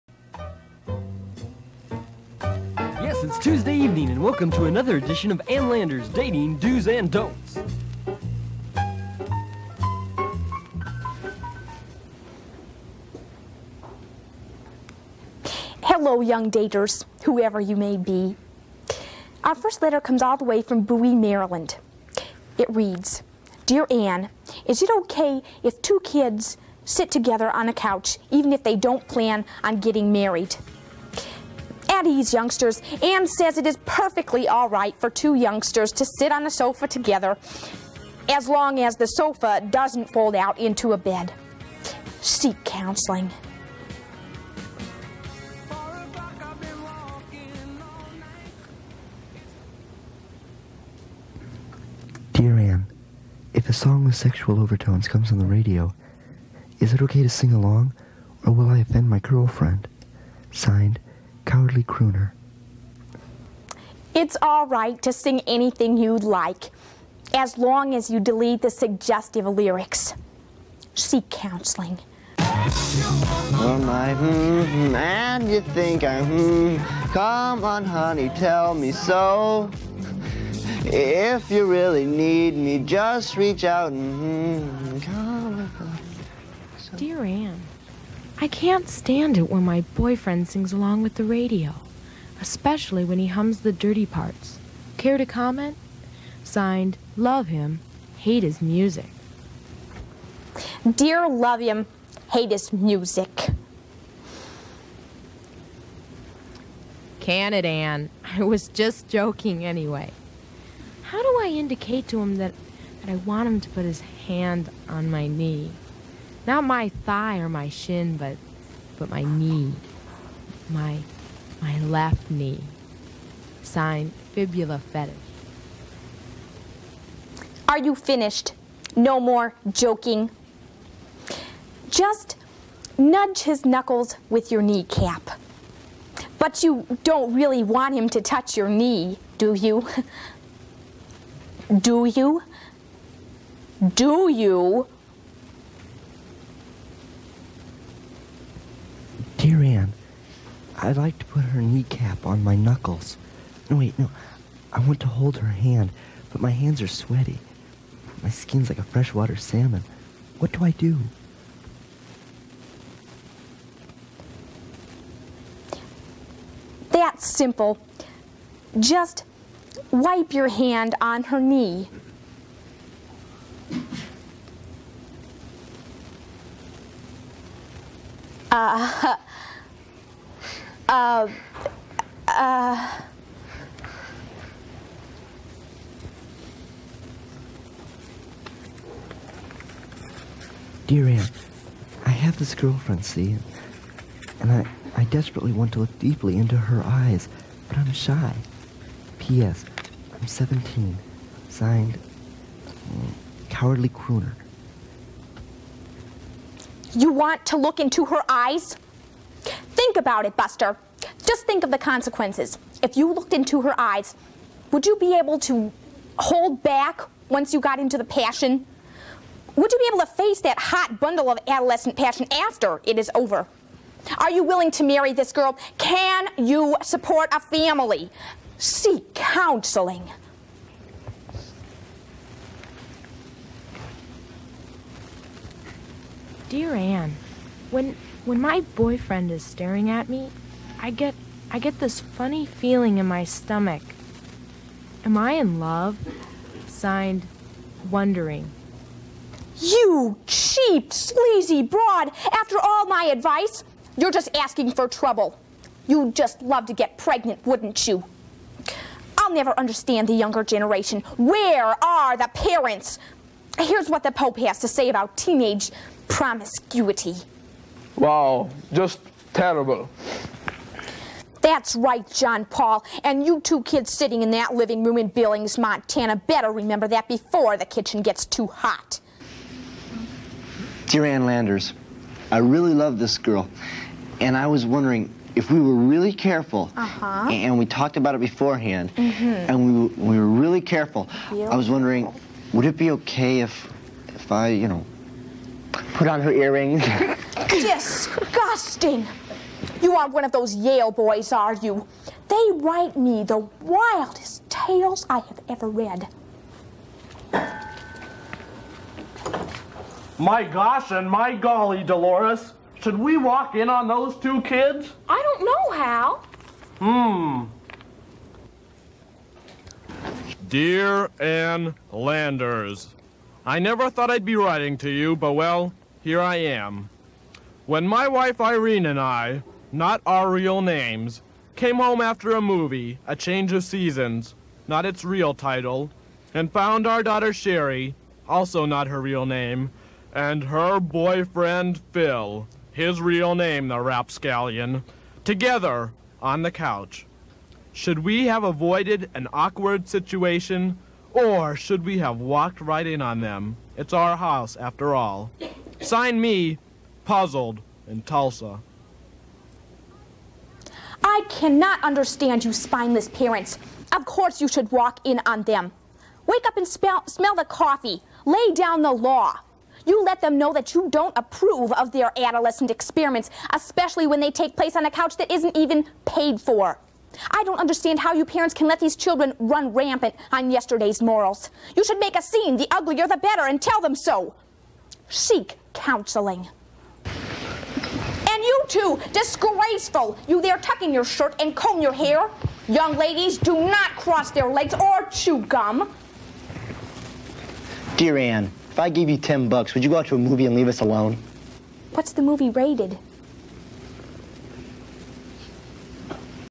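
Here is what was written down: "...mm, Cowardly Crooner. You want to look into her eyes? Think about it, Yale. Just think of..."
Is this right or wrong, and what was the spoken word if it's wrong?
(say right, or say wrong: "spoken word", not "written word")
wrong: "Buster", not "Yale".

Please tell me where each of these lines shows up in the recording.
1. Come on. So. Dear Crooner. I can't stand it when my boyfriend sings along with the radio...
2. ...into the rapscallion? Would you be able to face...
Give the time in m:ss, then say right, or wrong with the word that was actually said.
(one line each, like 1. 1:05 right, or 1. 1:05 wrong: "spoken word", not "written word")
1. 1:24 wrong: "Ann", not "Crooner"
2. 3:37 wrong: "passion", not "rapscallion".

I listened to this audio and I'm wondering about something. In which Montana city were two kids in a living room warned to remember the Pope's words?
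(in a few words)
Billings.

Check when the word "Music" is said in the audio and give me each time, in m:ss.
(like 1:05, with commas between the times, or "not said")
1:38, 1:42.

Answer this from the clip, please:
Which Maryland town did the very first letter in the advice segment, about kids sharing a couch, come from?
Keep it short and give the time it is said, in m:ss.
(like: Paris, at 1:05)
Bowie, at 0:20.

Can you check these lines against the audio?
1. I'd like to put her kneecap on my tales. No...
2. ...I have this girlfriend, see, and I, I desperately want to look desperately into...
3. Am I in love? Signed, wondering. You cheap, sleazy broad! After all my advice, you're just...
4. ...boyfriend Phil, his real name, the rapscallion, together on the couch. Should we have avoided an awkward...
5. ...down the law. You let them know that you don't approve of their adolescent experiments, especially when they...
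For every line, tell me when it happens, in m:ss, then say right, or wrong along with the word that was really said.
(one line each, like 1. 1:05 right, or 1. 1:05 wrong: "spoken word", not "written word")
1. 2:30 wrong: "knuckles", not "tales"
2. 3:12 wrong: "deeply", not "desperately"
3. 4:05 right
4. 5:40 right
5. 6:08 right.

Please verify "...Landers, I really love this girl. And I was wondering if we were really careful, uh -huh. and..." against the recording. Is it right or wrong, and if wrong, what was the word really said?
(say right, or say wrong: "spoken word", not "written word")
right.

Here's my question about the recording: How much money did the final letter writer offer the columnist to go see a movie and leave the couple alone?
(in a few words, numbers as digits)
10 bucks.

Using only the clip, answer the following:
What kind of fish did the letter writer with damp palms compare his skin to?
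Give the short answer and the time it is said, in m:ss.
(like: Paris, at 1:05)
Freshwater salmon, at 2:38.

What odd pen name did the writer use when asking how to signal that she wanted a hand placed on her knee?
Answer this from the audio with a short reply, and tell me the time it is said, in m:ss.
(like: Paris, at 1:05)
Fibula fetish, at 2:04.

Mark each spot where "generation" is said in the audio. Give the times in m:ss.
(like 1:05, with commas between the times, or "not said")
4:20.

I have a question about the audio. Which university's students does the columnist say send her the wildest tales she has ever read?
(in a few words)
Yale.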